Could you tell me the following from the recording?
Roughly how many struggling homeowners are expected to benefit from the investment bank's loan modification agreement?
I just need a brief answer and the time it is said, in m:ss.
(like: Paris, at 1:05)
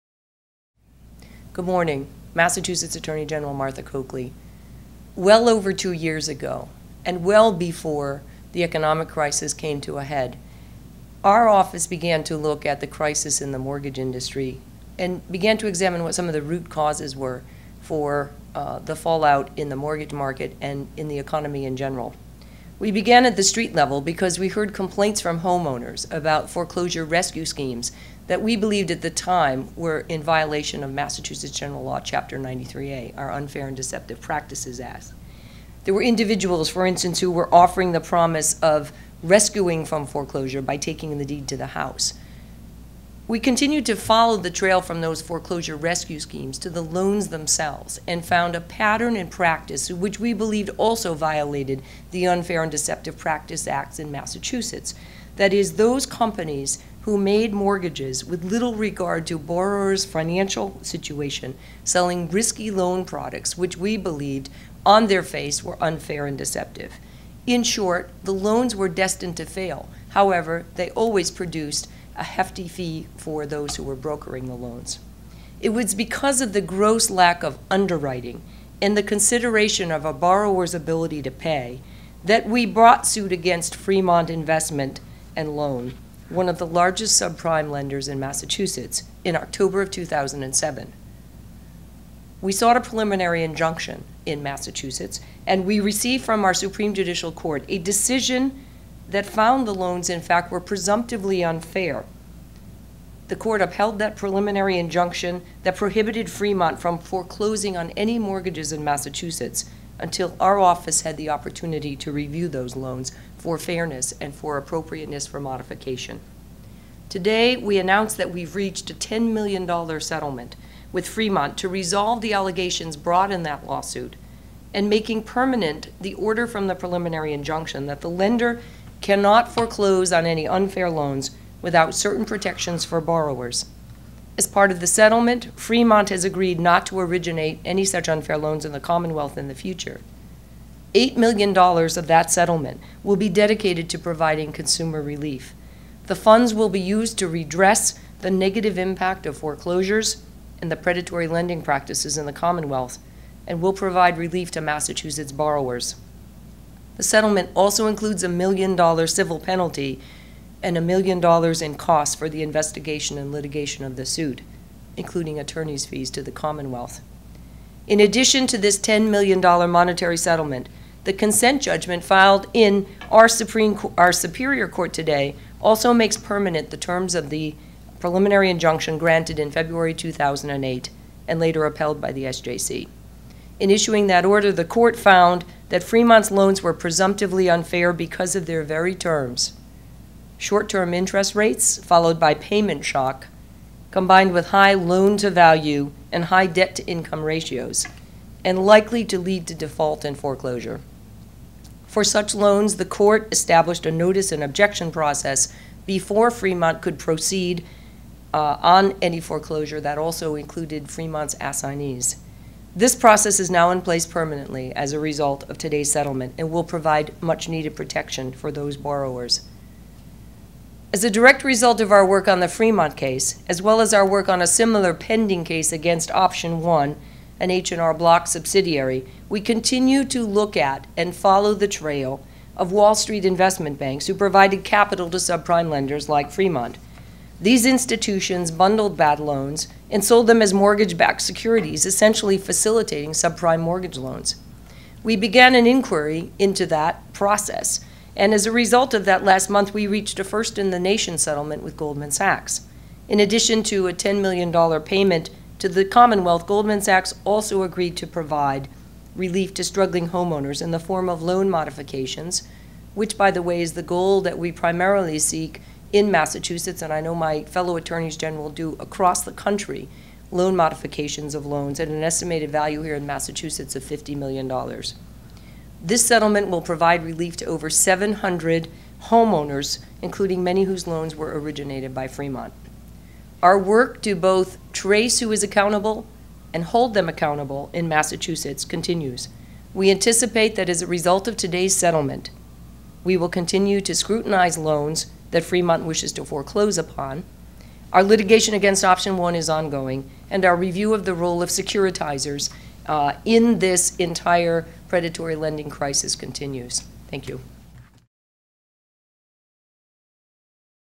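over 700, at 4:37.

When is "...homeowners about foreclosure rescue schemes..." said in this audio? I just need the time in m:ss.
0:25.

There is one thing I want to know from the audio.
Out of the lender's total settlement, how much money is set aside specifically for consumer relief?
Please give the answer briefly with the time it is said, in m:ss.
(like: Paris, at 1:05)
$8 million, at 2:20.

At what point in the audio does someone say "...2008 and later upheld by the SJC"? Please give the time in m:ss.
2:59.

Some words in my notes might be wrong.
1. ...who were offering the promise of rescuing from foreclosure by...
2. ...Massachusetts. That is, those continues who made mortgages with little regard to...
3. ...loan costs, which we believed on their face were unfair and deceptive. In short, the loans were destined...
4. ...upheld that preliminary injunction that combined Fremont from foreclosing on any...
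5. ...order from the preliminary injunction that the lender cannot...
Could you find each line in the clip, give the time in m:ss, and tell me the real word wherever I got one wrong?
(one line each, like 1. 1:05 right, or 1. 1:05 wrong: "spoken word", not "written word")
1. 0:37 right
2. 0:54 wrong: "companies", not "continues"
3. 1:02 wrong: "products", not "costs"
4. 1:43 wrong: "prohibited", not "combined"
5. 2:06 right.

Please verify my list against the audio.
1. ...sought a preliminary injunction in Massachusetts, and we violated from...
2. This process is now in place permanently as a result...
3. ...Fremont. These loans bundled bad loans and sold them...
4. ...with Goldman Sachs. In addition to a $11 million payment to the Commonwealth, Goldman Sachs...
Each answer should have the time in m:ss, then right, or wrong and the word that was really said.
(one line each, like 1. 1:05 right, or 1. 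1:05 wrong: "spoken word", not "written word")
1. 1:32 wrong: "received", not "violated"
2. 3:32 right
3. 3:56 wrong: "institutions", not "loans"
4. 4:11 wrong: "10", not "11".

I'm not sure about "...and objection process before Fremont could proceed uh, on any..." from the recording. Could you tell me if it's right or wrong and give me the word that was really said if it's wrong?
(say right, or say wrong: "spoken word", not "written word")
right.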